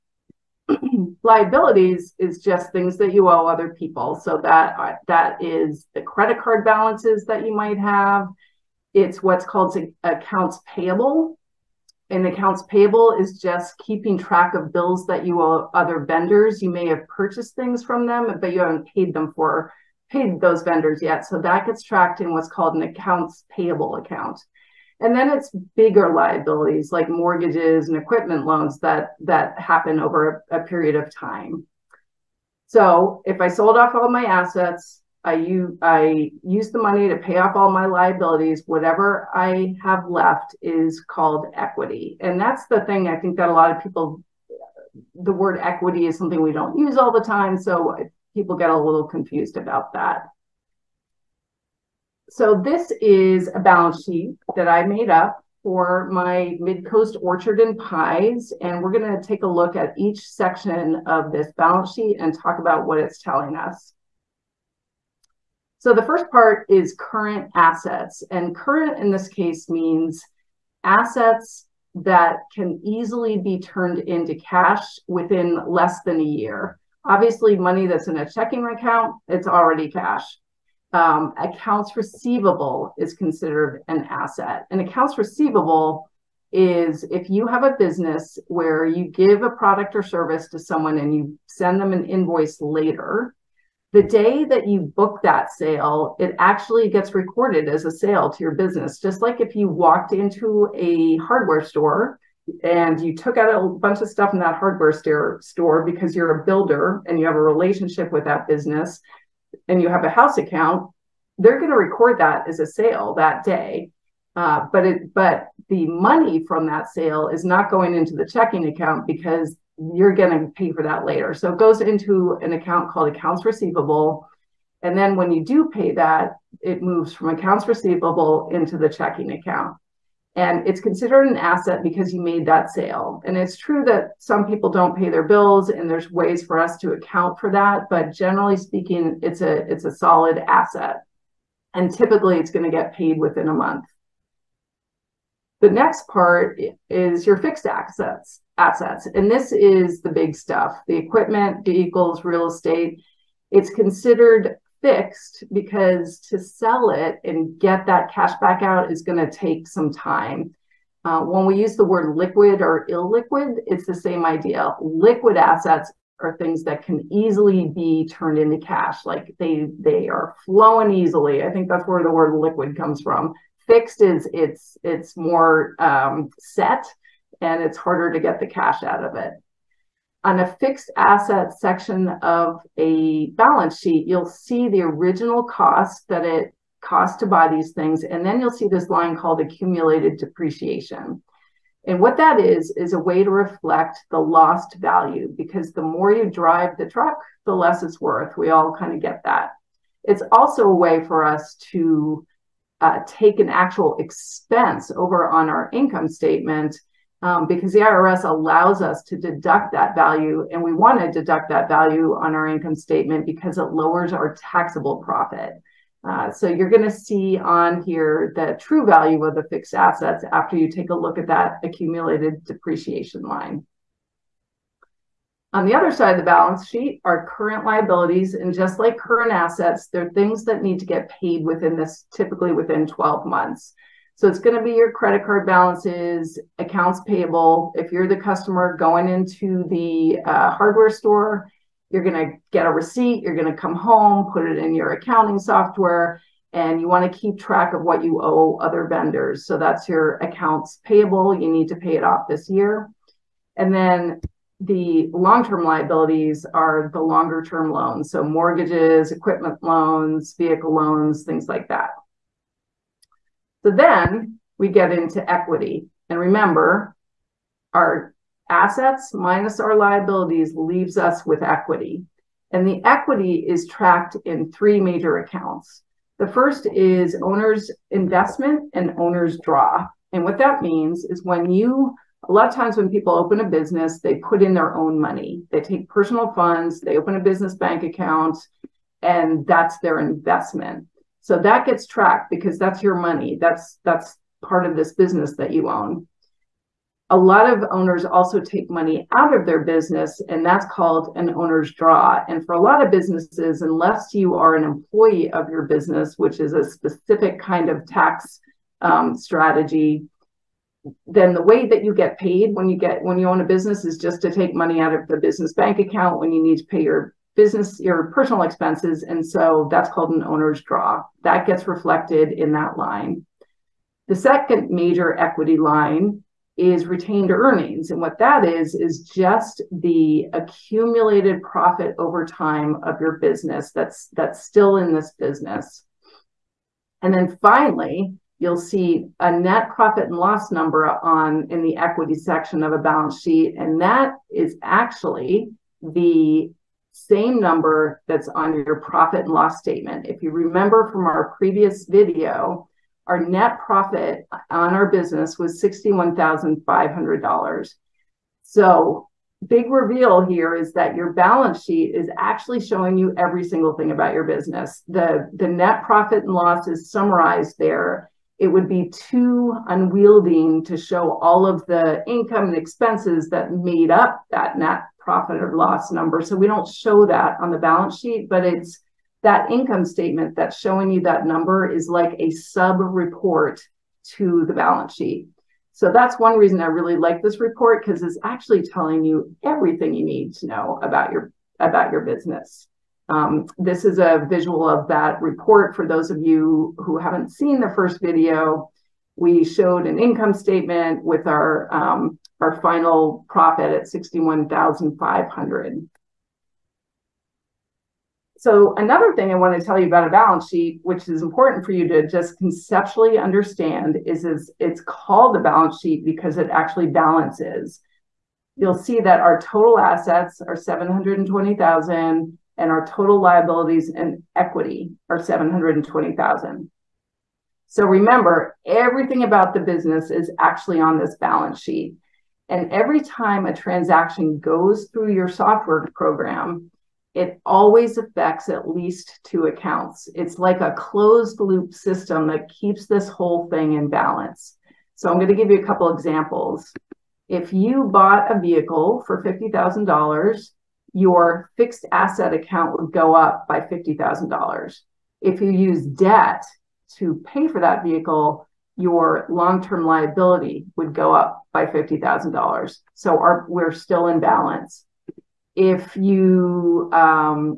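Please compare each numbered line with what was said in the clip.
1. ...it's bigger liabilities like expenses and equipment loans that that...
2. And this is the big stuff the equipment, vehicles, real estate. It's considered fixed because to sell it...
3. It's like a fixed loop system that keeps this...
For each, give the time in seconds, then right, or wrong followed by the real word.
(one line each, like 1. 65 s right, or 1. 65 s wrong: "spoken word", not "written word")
1. 25 s wrong: "mortgages", not "expenses"
2. 149 s right
3. 440 s wrong: "closed", not "fixed".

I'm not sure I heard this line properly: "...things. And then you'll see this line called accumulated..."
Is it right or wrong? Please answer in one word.
right.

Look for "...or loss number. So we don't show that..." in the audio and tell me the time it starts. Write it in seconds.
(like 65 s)
375 s.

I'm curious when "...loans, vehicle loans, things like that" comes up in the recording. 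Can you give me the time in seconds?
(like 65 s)
259 s.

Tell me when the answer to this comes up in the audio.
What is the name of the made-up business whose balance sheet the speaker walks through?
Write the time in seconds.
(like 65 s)
56 s.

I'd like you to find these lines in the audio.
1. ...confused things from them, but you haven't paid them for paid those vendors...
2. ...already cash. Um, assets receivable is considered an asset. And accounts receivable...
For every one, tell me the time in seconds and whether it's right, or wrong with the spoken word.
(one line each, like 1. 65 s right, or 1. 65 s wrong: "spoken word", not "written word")
1. 17 s wrong: "purchased", not "confused"
2. 79 s wrong: "accounts", not "assets".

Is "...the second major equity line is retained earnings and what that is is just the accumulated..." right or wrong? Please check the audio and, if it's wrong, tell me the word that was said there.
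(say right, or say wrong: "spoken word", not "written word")
right.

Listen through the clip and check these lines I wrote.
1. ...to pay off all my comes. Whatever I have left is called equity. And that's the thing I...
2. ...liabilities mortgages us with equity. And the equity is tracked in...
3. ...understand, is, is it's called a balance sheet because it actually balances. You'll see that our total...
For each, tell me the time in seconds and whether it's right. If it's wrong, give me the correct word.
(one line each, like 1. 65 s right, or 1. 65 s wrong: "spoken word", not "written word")
1. 37 s wrong: "liabilities", not "comes"
2. 269 s wrong: "leaves", not "mortgages"
3. 413 s right.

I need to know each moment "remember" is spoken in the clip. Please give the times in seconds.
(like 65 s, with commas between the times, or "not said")
266 s, 350 s, 427 s.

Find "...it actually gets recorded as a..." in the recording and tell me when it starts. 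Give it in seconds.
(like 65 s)
96 s.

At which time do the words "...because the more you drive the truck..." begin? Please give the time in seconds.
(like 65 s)
195 s.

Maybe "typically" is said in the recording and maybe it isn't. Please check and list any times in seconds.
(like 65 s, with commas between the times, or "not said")
141 s, 232 s.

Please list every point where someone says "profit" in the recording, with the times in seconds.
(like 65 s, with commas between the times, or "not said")
214 s, 331 s, 339 s, 348 s, 353 s, 365 s, 375 s, 403 s.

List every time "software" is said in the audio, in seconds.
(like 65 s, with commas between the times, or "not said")
245 s, 435 s.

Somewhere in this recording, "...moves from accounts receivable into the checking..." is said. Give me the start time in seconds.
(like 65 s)
126 s.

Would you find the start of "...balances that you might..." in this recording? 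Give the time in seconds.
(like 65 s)
6 s.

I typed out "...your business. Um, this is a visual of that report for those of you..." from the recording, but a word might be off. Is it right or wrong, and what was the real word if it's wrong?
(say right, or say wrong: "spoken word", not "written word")
right.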